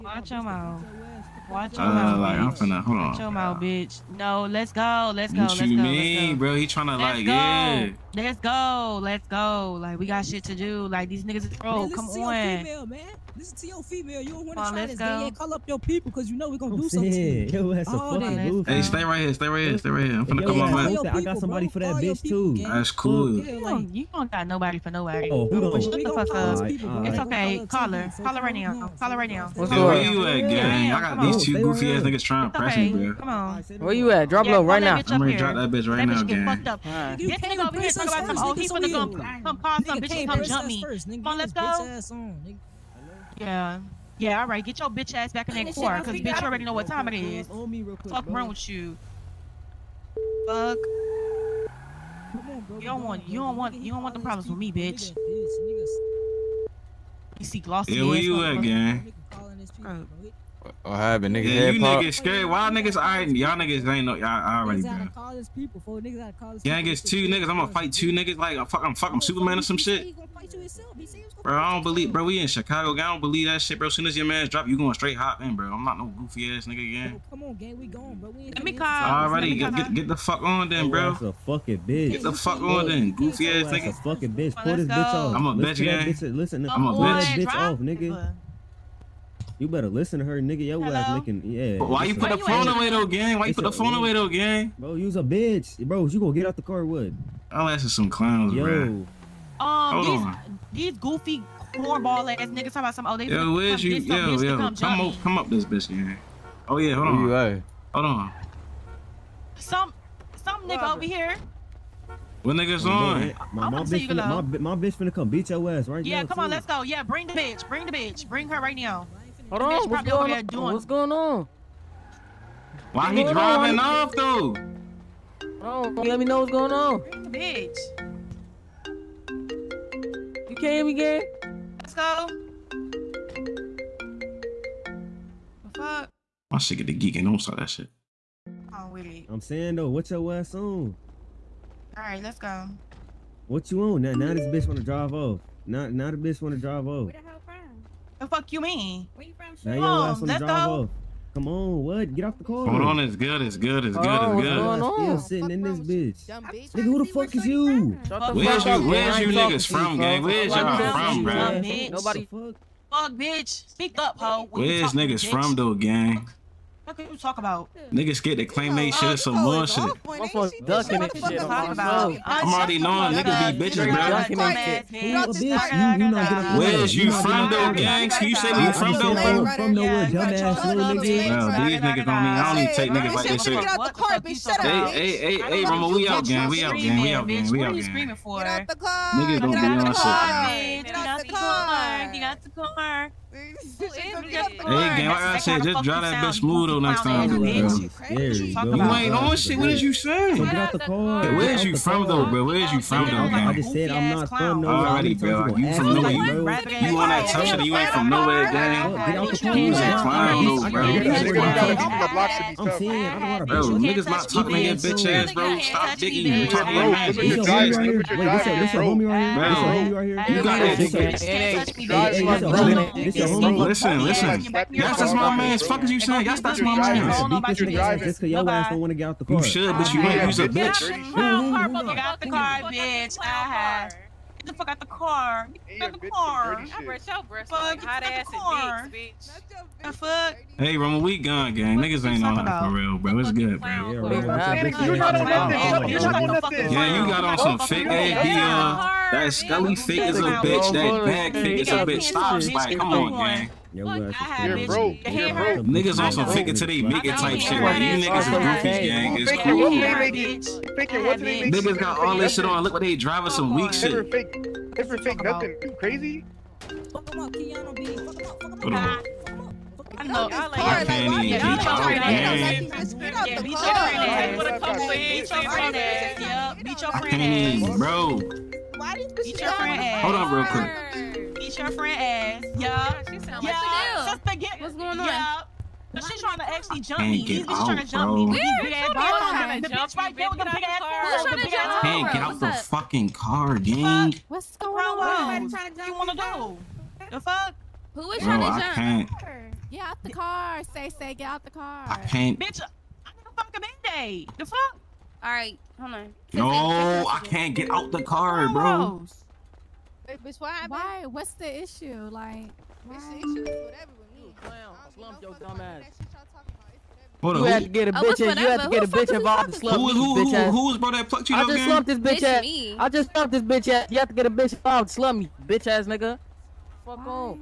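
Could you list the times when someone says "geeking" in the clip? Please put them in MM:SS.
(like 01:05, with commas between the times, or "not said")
02:16.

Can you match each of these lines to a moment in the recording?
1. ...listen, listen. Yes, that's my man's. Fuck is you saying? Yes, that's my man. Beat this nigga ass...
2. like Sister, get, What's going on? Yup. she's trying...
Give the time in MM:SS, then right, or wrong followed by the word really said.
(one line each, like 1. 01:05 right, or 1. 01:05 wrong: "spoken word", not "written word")
1. 03:43 right
2. 04:43 right.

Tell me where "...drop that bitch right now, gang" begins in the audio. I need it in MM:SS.
00:35.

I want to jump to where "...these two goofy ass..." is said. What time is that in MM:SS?
00:31.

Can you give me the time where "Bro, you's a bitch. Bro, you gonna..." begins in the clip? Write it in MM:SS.
01:34.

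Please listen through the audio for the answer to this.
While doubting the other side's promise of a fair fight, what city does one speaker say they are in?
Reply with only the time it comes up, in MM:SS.
01:12.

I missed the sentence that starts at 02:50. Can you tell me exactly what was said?
Motherfuckers I'm already knowing niggas be bitches, bro.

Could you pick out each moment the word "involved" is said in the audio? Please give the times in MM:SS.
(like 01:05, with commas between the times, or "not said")
05:19, 05:24.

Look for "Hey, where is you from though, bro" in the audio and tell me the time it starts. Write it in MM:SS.
03:20.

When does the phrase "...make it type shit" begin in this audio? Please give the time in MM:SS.
04:16.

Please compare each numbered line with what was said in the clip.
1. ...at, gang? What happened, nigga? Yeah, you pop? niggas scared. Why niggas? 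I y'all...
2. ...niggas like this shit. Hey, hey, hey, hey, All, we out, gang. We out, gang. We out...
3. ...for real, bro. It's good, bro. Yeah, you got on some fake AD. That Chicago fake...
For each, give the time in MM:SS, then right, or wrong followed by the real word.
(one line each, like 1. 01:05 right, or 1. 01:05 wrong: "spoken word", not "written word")
1. 00:58 right
2. 03:02 wrong: "Rama", not "All"
3. 04:02 wrong: "Scully", not "Chicago".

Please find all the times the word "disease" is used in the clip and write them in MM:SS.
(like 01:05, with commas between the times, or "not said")
not said.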